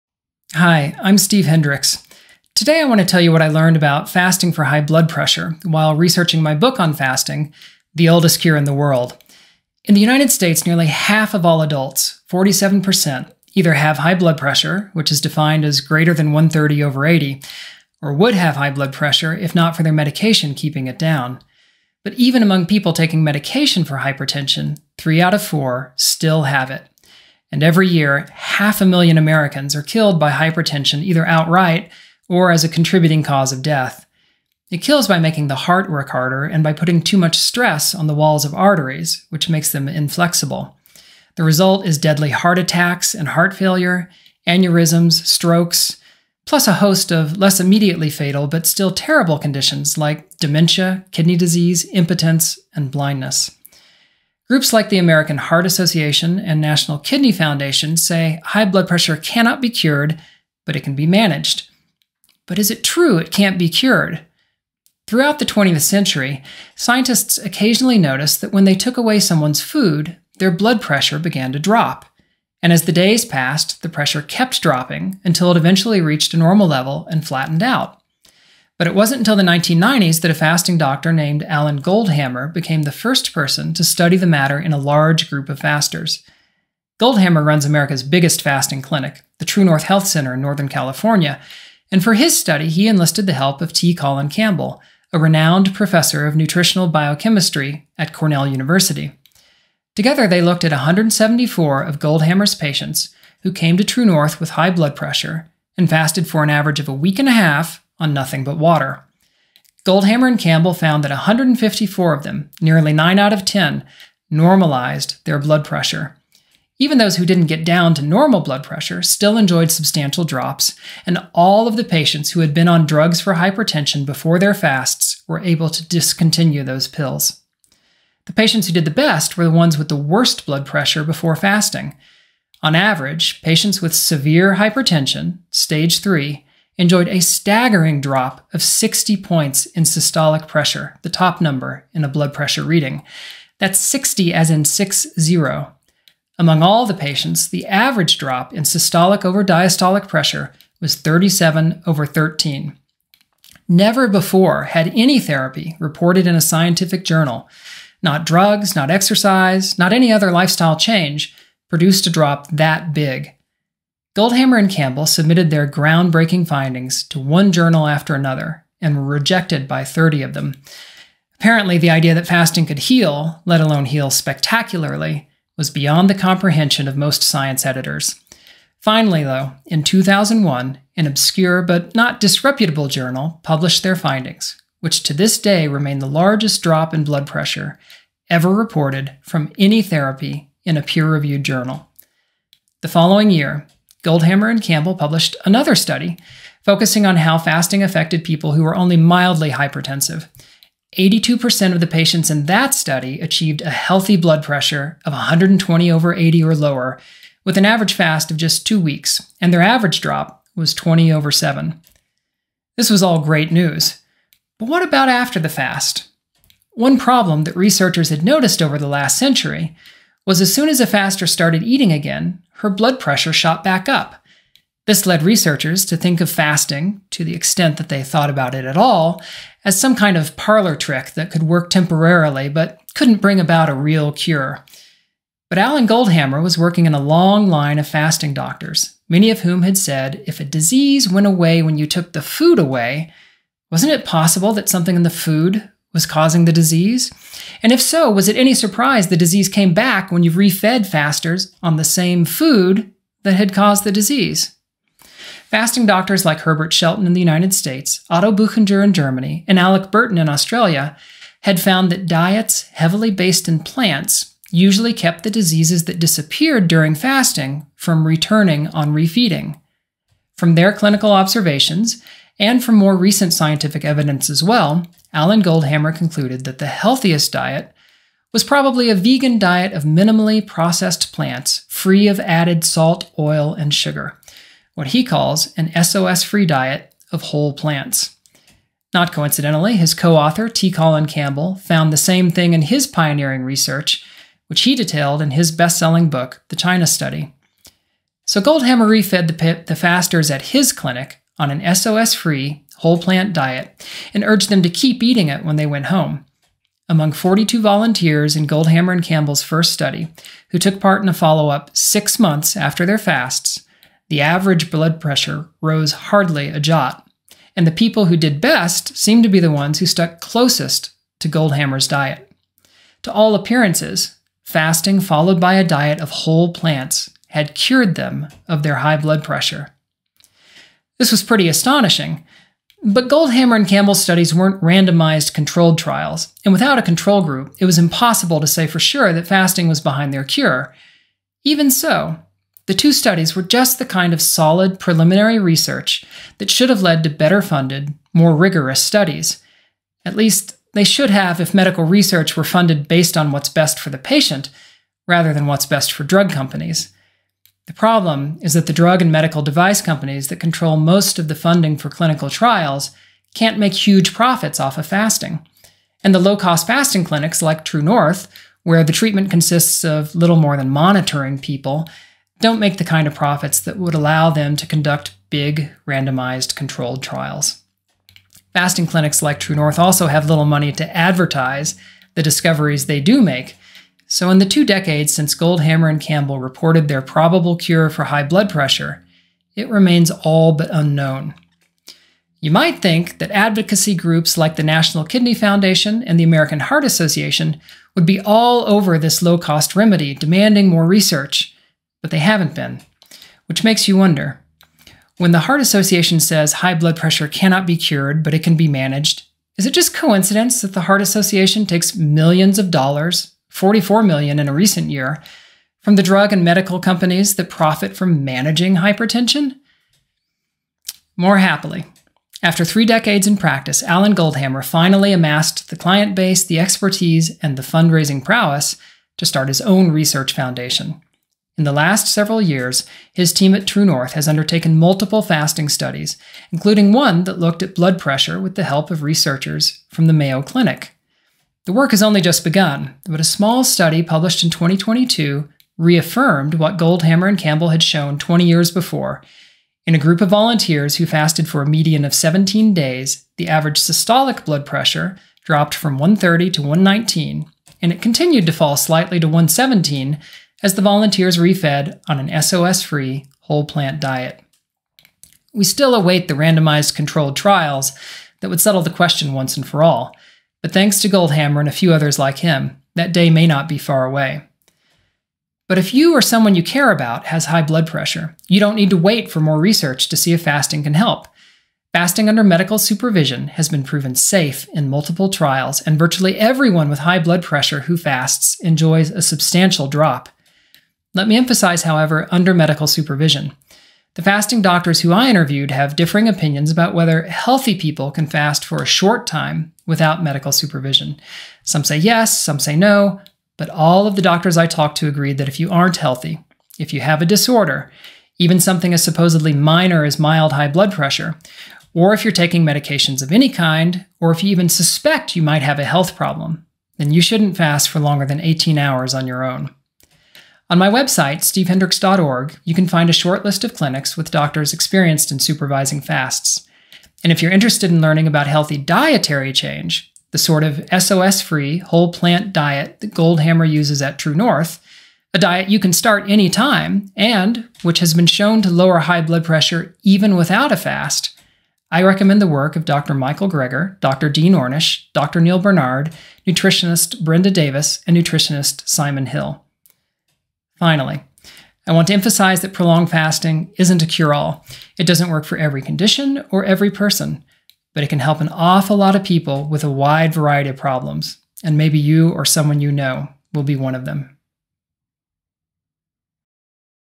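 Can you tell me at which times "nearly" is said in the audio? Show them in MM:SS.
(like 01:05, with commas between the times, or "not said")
00:10, 01:52.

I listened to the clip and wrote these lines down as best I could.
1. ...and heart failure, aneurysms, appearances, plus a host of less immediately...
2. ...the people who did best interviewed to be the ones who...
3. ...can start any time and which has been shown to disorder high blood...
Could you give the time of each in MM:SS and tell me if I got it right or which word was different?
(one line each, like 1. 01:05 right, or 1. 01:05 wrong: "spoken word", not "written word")
1. 00:43 wrong: "strokes", not "appearances"
2. 05:17 wrong: "seemed", not "interviewed"
3. 08:55 wrong: "lower", not "disorder".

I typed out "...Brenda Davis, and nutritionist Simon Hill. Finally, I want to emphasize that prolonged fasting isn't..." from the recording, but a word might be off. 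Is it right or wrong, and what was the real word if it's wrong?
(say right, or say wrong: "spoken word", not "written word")
right.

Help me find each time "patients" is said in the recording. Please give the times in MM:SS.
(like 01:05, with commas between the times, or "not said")
01:42, 02:01, 02:08, 02:13, 02:26, 03:21, 05:53.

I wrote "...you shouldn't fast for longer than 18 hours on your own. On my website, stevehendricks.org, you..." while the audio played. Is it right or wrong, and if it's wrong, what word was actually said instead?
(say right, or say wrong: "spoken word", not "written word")
right.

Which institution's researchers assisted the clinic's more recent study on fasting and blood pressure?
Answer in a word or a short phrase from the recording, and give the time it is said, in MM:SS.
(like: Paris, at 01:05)
Mayo Clinic, at 07:20.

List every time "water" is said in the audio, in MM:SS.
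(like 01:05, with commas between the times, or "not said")
01:48.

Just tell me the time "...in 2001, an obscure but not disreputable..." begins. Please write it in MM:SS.
02:59.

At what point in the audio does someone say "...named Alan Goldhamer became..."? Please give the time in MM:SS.
01:21.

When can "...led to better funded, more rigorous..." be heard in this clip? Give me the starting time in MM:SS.
05:46.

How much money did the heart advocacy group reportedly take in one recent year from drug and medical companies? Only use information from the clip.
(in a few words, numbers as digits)
$44 million.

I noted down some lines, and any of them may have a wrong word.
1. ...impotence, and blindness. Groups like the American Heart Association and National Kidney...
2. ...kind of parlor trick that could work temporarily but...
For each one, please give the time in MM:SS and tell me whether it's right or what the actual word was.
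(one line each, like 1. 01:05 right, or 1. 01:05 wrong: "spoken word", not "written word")
1. 00:51 right
2. 03:49 right.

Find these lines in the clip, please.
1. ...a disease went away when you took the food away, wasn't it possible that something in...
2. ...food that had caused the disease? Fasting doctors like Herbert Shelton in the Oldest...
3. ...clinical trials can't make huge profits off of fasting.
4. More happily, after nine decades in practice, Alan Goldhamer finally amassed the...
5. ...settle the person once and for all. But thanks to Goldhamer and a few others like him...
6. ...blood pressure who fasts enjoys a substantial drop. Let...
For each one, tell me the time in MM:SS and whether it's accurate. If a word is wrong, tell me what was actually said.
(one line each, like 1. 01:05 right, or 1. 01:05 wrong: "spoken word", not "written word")
1. 04:00 right
2. 04:12 wrong: "United", not "Oldest"
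3. 06:01 right
4. 07:01 wrong: "three", not "nine"
5. 07:48 wrong: "question", not "person"
6. 08:07 right.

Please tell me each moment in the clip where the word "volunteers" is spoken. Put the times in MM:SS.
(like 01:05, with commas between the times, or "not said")
05:07, 07:30, 07:40.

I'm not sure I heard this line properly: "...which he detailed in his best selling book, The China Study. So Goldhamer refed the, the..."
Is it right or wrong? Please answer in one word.
right.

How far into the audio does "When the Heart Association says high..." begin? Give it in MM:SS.
06:45.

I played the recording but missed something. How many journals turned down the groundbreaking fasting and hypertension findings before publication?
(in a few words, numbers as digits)
30.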